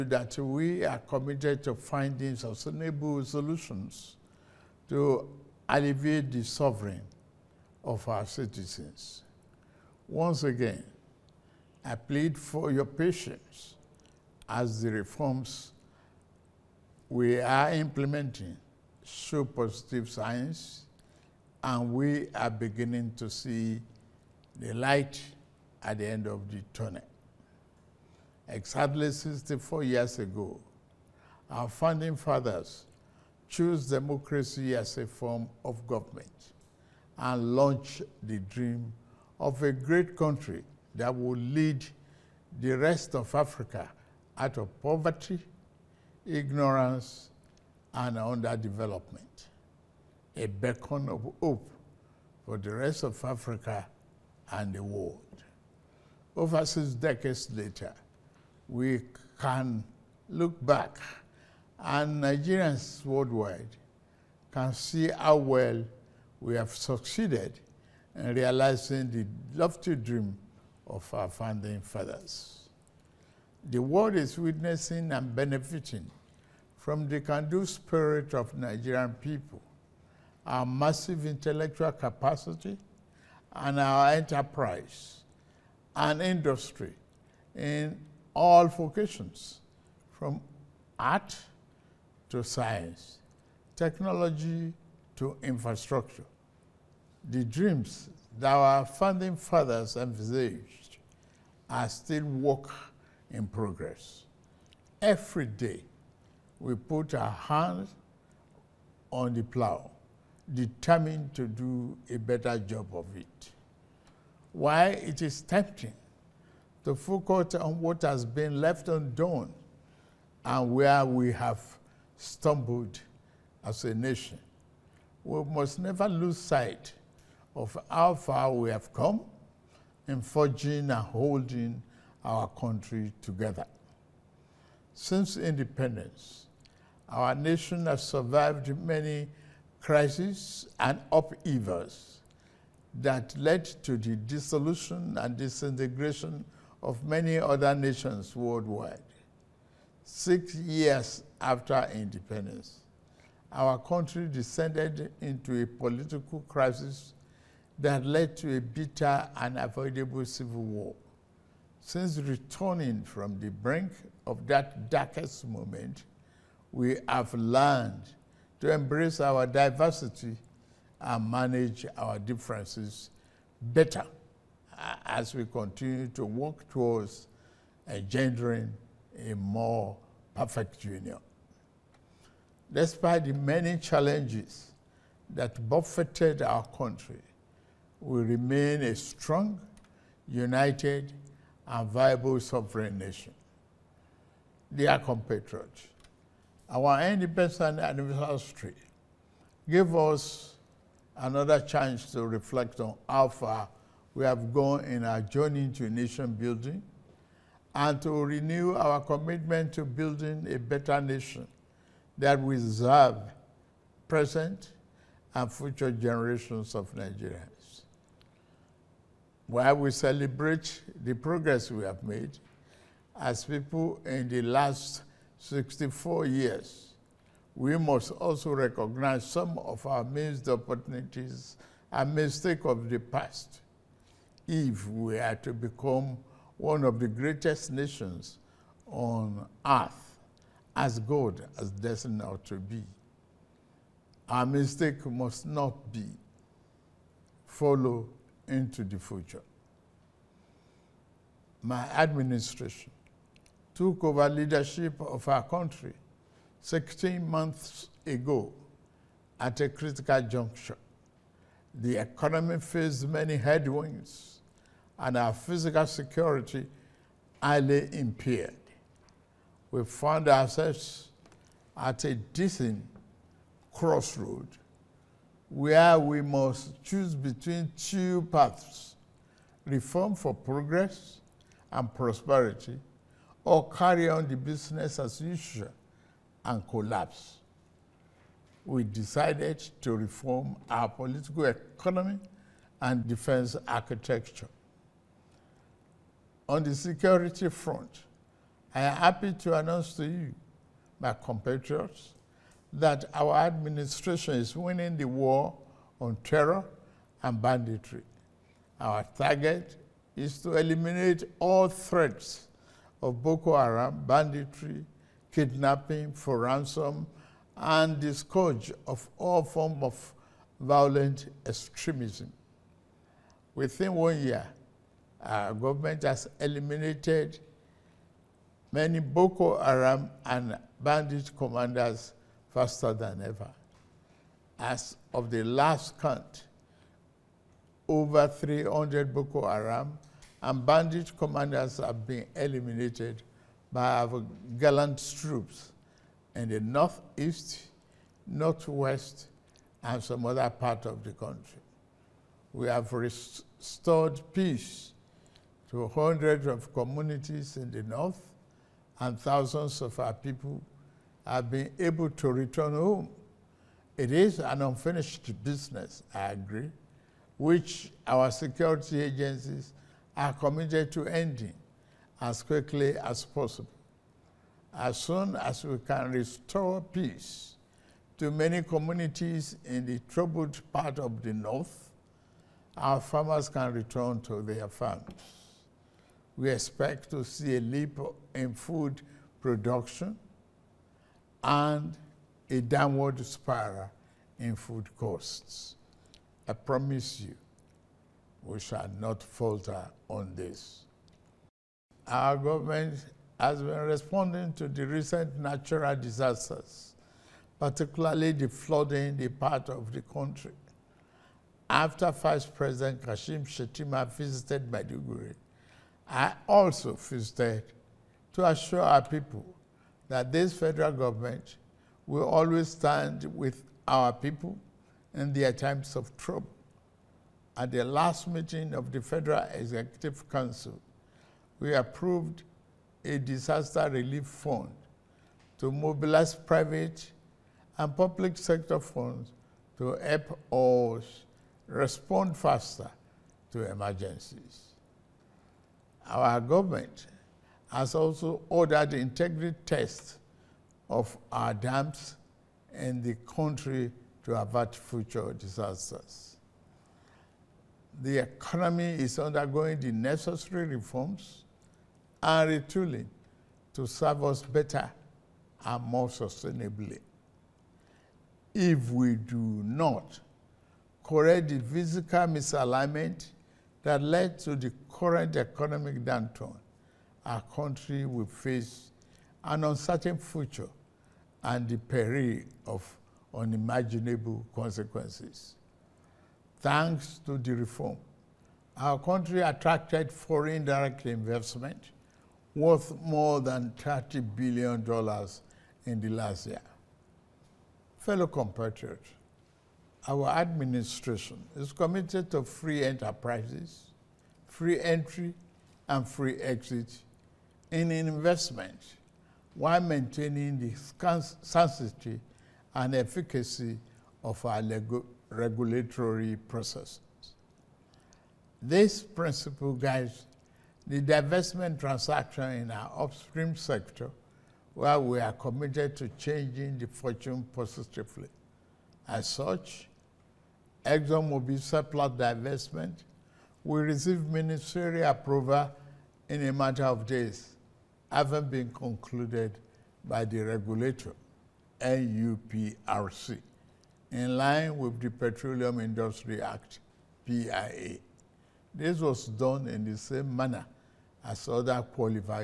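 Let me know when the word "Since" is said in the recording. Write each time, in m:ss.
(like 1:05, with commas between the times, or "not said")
2:14, 2:41.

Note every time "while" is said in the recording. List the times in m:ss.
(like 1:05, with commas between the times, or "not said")
3:39, 8:29.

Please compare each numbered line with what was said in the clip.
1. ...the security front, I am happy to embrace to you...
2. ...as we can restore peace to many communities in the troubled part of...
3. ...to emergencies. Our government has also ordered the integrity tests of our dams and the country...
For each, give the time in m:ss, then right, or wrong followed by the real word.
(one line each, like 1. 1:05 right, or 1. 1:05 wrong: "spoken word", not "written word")
1. 4:56 wrong: "announce", not "embrace"
2. 6:15 right
3. 7:23 right.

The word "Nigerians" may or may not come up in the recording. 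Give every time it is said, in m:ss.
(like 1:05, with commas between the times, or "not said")
1:02, 1:18, 3:36.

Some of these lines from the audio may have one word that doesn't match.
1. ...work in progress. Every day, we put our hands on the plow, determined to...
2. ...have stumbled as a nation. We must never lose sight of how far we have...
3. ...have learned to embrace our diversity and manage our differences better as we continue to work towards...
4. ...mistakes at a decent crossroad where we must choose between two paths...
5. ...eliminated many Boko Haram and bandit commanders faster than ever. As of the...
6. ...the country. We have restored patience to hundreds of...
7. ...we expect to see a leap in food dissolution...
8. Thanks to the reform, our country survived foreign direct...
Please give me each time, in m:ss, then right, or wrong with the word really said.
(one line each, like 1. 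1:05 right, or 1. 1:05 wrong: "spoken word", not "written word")
1. 1:42 right
2. 2:01 right
3. 2:47 right
4. 4:30 wrong: "ourselves", not "mistakes"
5. 5:26 right
6. 5:51 wrong: "peace", not "patience"
7. 6:26 wrong: "production", not "dissolution"
8. 8:06 wrong: "attracted", not "survived".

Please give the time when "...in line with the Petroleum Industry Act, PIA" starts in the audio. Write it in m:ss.
9:04.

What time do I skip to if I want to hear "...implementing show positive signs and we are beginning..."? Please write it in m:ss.
0:17.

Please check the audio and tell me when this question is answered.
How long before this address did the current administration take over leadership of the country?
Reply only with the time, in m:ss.
4:16.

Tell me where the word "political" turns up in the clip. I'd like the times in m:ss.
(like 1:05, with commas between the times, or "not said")
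2:35, 4:50.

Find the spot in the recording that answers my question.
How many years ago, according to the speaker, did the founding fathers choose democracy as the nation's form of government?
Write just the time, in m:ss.
0:28.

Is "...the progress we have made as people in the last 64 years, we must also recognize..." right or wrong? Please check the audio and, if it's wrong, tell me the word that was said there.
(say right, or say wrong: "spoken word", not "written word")
right.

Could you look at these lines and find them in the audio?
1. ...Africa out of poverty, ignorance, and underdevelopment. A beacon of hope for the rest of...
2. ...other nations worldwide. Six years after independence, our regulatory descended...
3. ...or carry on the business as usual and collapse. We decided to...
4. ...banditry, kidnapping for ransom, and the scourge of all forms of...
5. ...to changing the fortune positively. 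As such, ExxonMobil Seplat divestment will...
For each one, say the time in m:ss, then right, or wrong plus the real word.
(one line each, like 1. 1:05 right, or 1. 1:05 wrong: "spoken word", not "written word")
1. 0:43 right
2. 2:27 wrong: "country", not "regulatory"
3. 4:43 right
4. 5:14 right
5. 8:45 right.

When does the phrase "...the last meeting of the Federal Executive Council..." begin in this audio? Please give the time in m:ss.
7:07.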